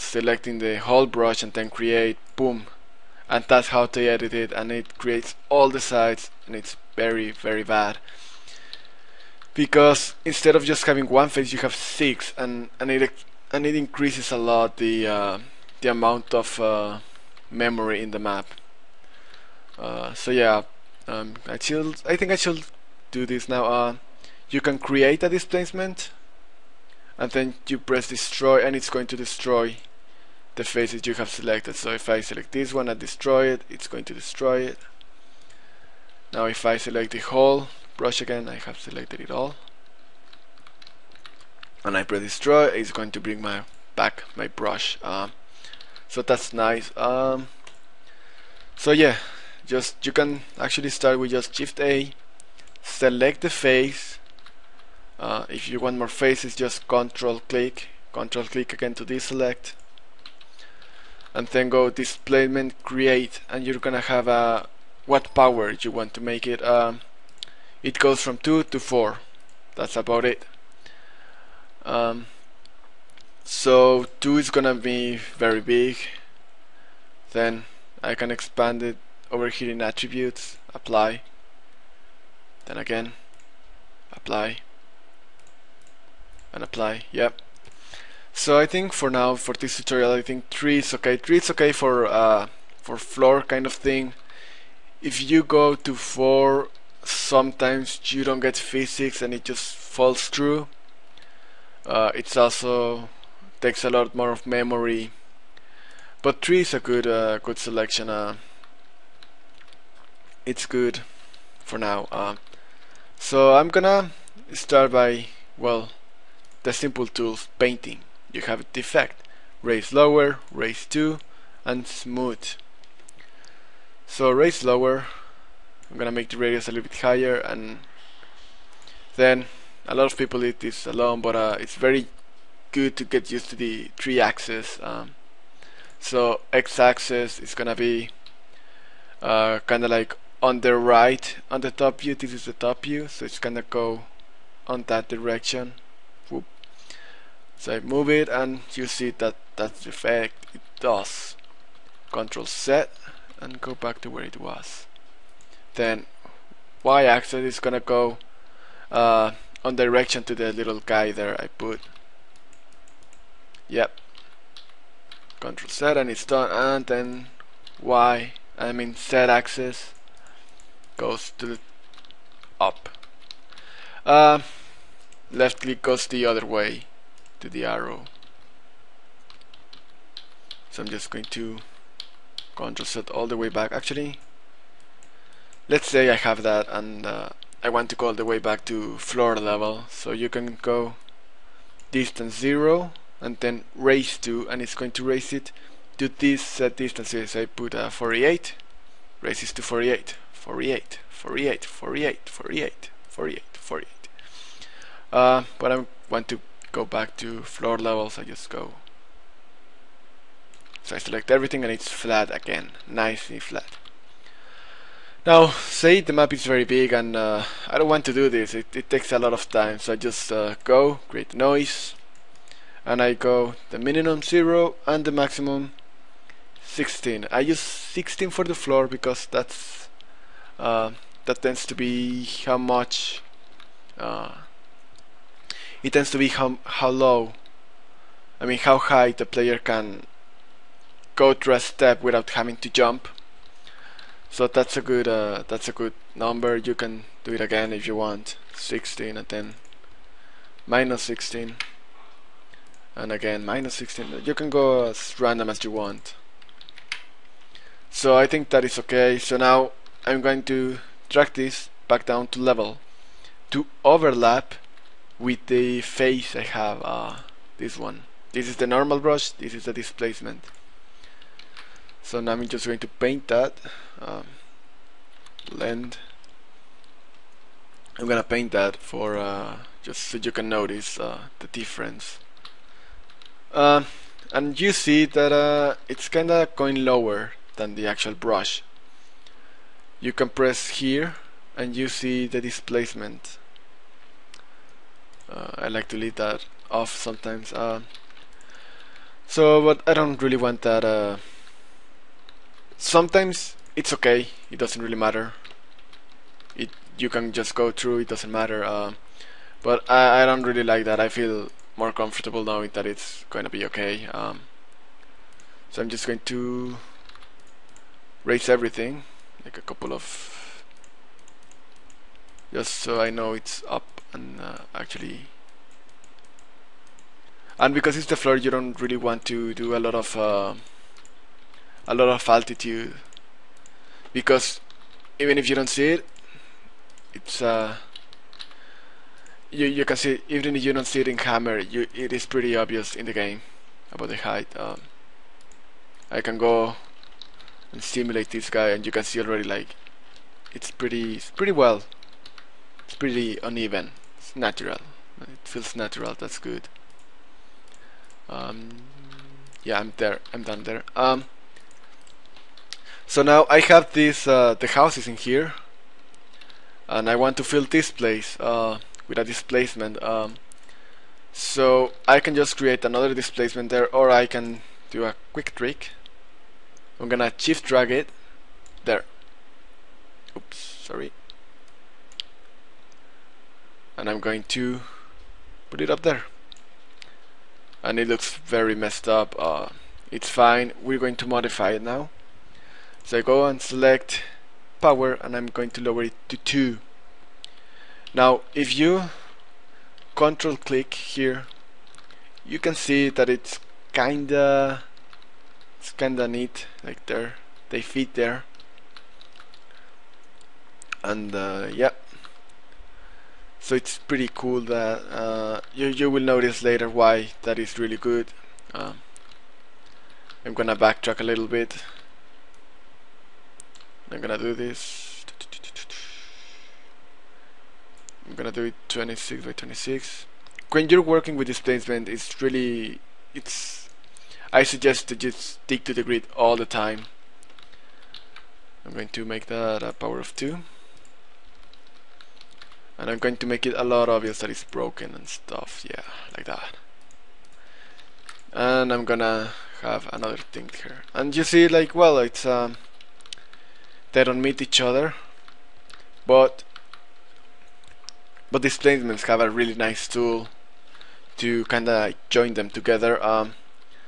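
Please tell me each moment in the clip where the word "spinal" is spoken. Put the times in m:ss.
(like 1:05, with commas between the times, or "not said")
not said.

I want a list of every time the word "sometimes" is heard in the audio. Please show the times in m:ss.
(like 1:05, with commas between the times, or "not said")
1:37, 4:56, 5:02.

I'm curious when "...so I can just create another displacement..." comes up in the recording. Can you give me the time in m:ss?
6:11.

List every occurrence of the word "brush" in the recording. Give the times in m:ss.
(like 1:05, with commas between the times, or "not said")
0:01, 0:37, 0:44, 4:28, 4:48.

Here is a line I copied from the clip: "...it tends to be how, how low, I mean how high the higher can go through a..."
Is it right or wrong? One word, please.
wrong.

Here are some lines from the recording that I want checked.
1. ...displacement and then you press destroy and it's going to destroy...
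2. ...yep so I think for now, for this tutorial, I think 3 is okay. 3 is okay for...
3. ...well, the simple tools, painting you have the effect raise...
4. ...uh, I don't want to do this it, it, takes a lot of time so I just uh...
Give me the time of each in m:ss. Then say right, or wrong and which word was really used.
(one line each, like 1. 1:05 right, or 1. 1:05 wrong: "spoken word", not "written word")
1. 0:25 right
2. 1:27 right
3. 1:55 right
4. 3:37 right.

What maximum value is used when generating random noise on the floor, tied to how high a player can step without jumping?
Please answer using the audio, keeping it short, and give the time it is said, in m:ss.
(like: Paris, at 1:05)
16, at 3:45.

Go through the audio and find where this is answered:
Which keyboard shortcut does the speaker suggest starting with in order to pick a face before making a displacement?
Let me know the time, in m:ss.
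0:51.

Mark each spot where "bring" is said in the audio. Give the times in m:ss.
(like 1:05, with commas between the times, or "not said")
0:43.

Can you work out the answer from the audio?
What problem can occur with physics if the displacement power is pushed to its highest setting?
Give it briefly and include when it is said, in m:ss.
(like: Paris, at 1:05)
Falls through, at 1:39.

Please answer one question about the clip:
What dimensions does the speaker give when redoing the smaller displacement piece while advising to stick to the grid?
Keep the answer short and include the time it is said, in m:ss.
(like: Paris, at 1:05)
26 by 26, at 7:08.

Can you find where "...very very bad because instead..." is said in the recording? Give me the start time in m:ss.
0:06.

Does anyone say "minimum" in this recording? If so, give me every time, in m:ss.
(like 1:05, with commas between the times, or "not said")
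3:43.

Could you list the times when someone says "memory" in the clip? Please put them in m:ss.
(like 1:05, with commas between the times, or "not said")
0:17, 1:44.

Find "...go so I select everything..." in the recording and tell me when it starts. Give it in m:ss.
3:28.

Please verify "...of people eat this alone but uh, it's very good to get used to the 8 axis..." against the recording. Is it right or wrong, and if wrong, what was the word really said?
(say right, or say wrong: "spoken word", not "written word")
wrong: "3", not "8".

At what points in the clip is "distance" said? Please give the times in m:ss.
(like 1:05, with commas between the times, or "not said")
3:11, 3:16.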